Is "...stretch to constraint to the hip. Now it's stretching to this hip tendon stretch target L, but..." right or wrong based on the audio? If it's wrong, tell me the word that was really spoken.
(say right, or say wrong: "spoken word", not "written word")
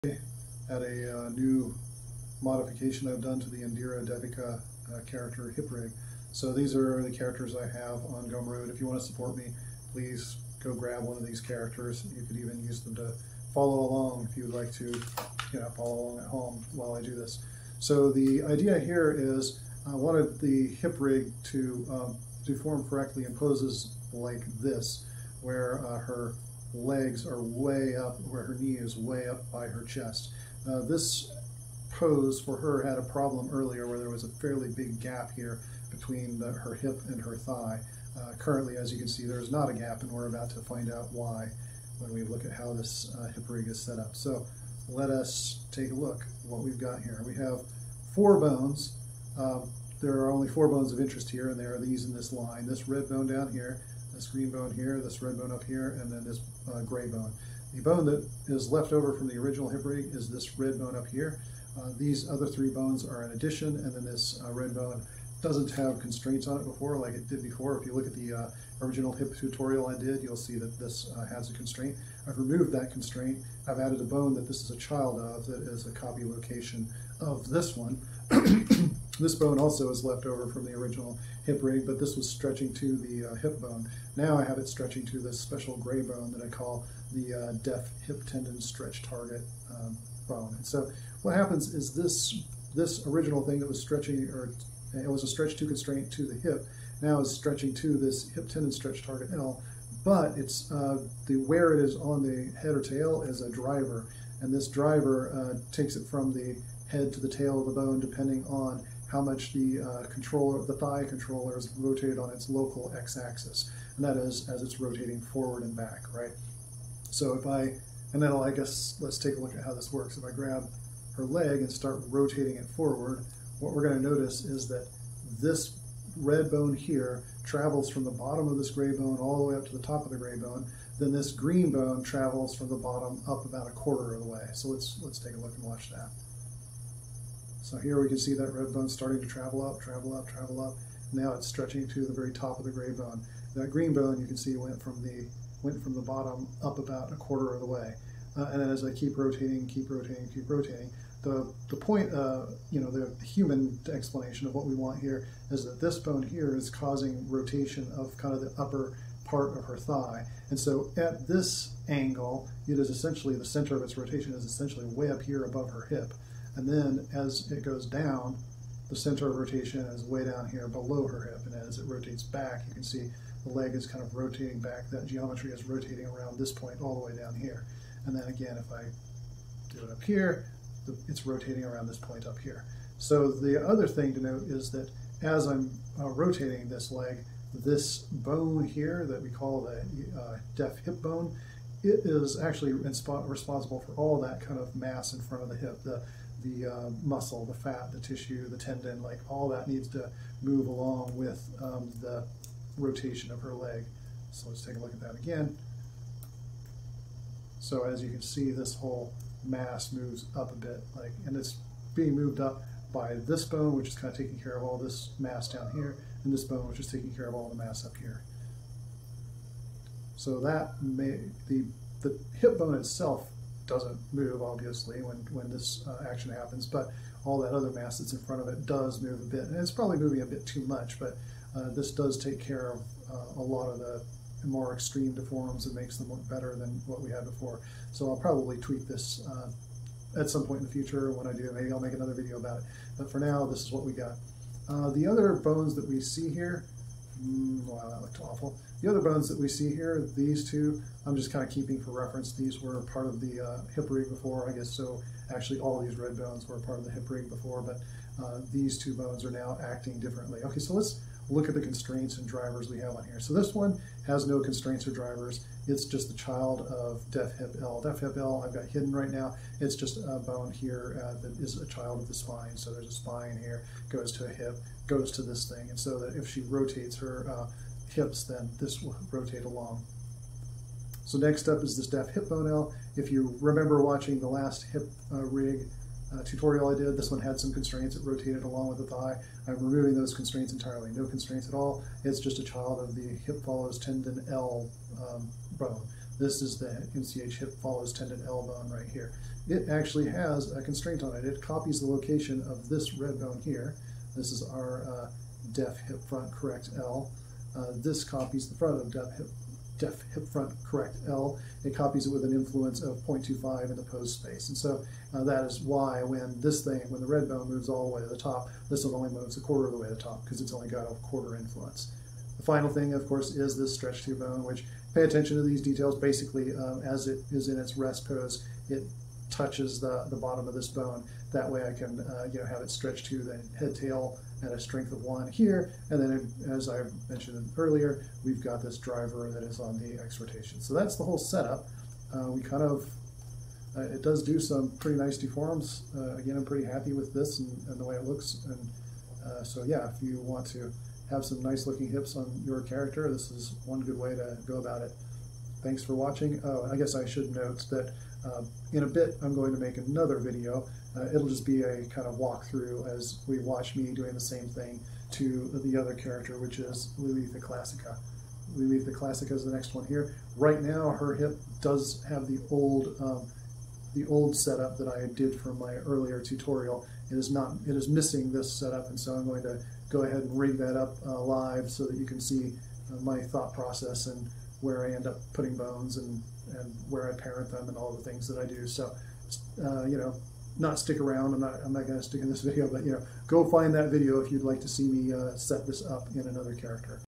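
right.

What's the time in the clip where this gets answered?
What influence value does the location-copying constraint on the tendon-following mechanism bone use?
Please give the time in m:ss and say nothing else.
5:12.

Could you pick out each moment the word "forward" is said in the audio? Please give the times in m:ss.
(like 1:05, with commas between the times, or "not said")
1:55, 2:02.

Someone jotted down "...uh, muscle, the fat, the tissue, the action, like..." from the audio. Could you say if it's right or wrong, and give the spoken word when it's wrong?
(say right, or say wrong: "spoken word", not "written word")
wrong: "tendon", not "action".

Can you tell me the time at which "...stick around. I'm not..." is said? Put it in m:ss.
6:30.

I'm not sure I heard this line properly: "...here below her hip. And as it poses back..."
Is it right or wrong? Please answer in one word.
wrong.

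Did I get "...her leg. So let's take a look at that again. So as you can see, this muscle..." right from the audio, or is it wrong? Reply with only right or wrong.
wrong.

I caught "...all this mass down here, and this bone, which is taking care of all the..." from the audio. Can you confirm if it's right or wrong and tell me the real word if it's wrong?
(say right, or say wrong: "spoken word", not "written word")
right.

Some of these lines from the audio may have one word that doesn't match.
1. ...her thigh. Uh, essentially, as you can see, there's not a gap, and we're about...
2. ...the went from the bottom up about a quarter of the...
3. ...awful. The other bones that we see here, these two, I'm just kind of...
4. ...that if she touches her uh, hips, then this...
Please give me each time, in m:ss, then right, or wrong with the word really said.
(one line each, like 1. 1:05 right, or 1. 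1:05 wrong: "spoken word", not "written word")
1. 0:37 wrong: "currently", not "essentially"
2. 2:25 right
3. 4:08 right
4. 4:35 wrong: "rotates", not "touches".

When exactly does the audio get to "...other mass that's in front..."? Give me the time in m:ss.
3:47.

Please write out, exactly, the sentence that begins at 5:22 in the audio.
The final thing, of course, is this stretch through bone, which pay attention to these details.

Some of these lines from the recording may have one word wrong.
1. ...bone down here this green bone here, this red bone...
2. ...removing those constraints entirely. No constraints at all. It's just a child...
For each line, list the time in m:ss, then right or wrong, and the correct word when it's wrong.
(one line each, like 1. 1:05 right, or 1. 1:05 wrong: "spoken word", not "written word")
1. 0:53 right
2. 4:49 right.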